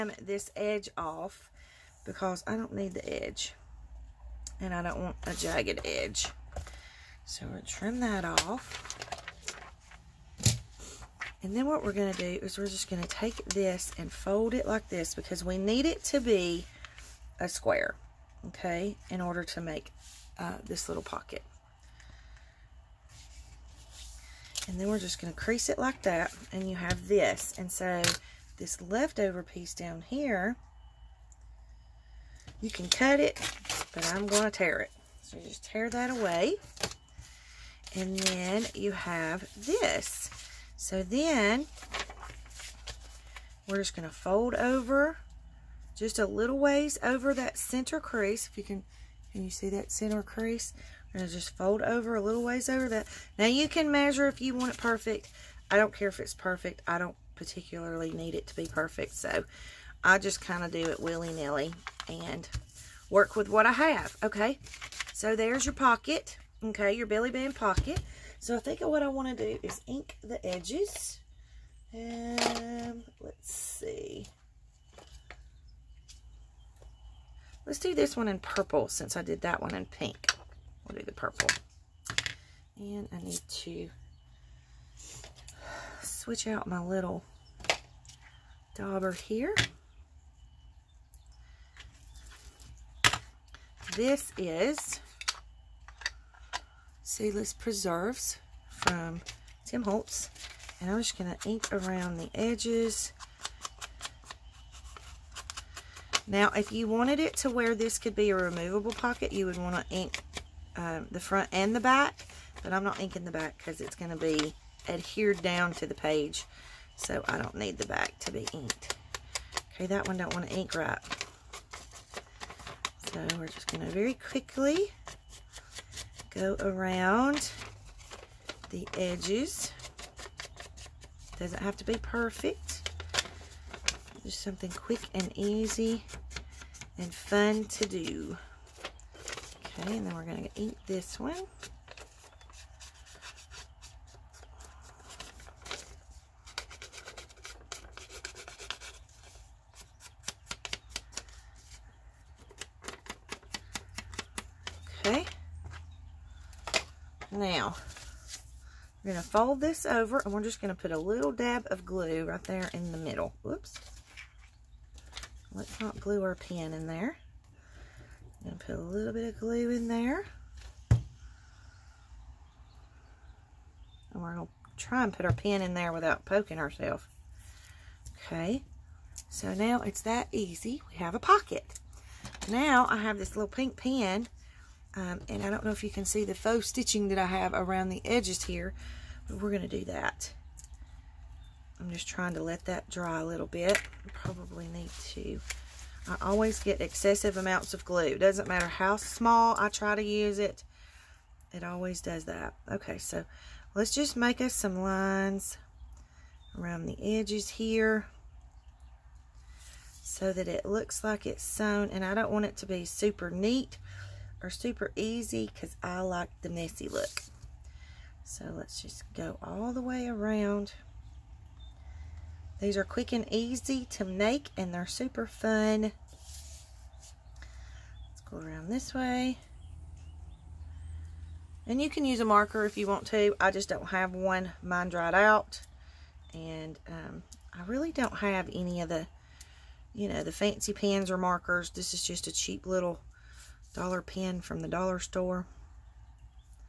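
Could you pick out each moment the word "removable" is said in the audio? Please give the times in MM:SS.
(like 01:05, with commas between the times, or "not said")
01:48.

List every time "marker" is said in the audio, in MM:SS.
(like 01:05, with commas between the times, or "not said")
03:52, 04:01.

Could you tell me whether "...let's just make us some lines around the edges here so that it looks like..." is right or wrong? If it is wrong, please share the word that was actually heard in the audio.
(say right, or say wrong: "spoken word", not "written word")
right.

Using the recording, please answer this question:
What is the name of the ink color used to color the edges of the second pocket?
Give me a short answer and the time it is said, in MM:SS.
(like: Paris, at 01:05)
Seedless Preserves, at 01:37.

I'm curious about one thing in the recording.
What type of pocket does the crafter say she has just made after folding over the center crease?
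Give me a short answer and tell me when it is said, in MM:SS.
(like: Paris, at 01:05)
belly band pocket, at 01:07.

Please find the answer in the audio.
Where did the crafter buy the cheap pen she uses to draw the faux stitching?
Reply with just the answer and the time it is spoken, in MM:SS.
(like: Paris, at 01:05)
the dollar store, at 04:04.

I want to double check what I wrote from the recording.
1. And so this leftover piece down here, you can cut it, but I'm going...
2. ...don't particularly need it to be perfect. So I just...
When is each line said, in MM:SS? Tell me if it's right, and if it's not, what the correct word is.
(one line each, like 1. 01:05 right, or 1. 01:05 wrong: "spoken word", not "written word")
1. 00:27 right
2. 00:56 right.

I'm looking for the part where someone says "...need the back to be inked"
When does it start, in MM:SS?
01:57.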